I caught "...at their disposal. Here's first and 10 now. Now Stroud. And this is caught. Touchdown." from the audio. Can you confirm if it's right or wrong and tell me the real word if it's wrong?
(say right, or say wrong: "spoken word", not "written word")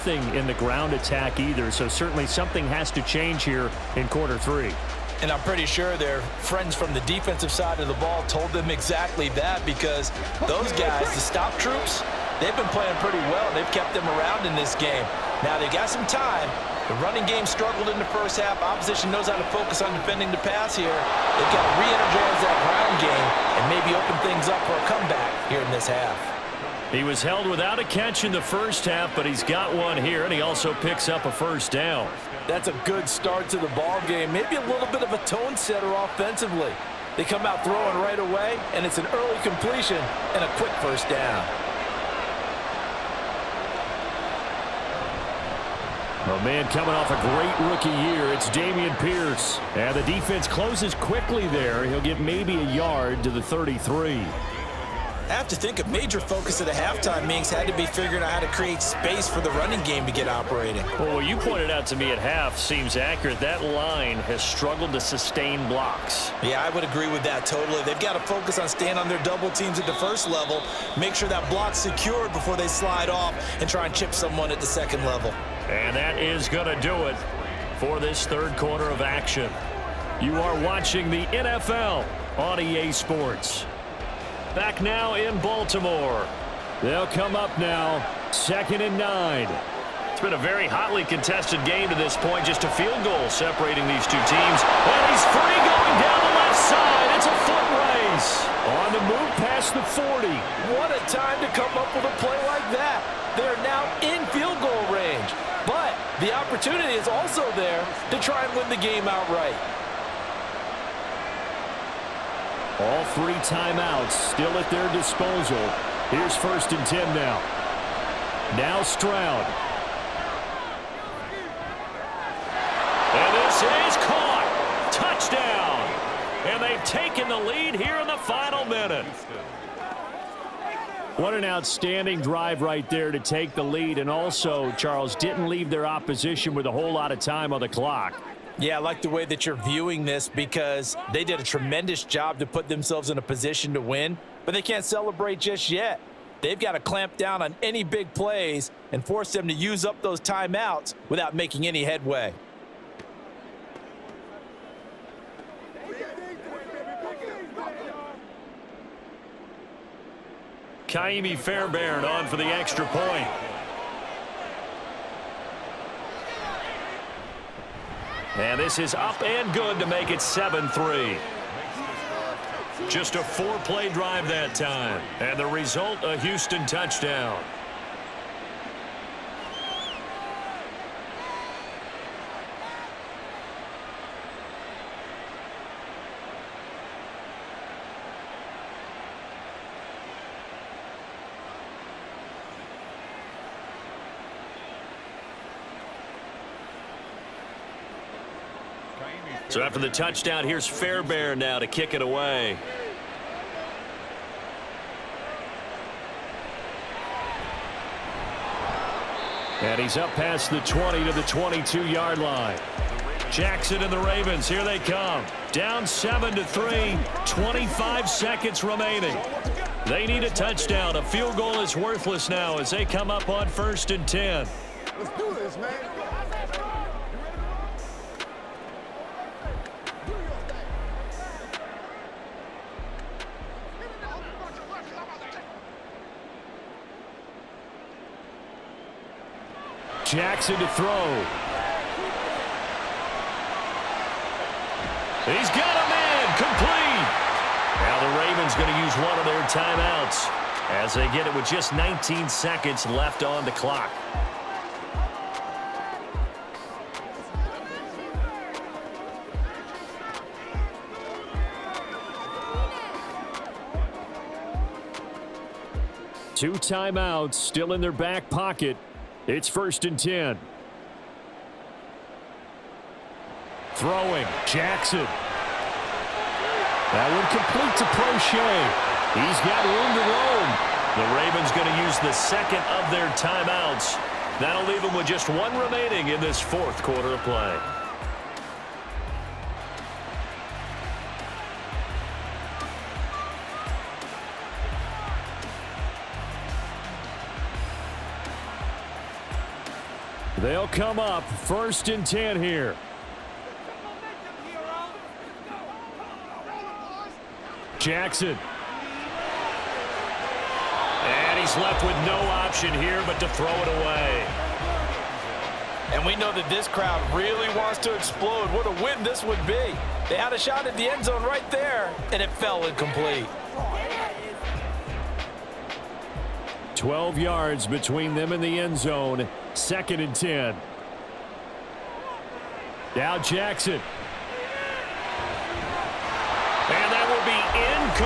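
right.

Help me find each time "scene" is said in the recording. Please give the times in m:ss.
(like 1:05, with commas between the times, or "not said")
not said.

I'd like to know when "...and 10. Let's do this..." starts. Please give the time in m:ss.
3:43.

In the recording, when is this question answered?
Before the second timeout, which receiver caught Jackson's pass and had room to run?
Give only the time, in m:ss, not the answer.
4:37.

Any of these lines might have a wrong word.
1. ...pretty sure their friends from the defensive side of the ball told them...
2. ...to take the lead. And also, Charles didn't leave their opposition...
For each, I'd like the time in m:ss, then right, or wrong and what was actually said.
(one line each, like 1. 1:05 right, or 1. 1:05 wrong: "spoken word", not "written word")
1. 0:05 right
2. 2:13 right.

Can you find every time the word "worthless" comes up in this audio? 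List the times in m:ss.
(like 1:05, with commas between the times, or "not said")
3:41.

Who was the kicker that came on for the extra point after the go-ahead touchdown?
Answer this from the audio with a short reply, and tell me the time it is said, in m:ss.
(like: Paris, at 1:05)
Kaimi Fairbairn, at 2:40.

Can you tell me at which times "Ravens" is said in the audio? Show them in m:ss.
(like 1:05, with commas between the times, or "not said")
3:33, 4:08, 4:41.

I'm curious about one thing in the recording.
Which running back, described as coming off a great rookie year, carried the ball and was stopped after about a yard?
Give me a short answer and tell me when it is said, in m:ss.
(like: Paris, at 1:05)
Dameon Pierce, at 0:48.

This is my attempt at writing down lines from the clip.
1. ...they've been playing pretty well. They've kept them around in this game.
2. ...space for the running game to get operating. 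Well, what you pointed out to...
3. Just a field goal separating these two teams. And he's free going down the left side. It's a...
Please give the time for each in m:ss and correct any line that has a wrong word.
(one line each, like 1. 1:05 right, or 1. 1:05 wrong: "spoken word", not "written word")
1. 0:12 right
2. 0:58 right
3. 1:32 right.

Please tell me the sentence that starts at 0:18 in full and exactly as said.
Opposition knows how to focus on defending the pass here.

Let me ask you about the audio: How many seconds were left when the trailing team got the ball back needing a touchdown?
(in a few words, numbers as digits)
25.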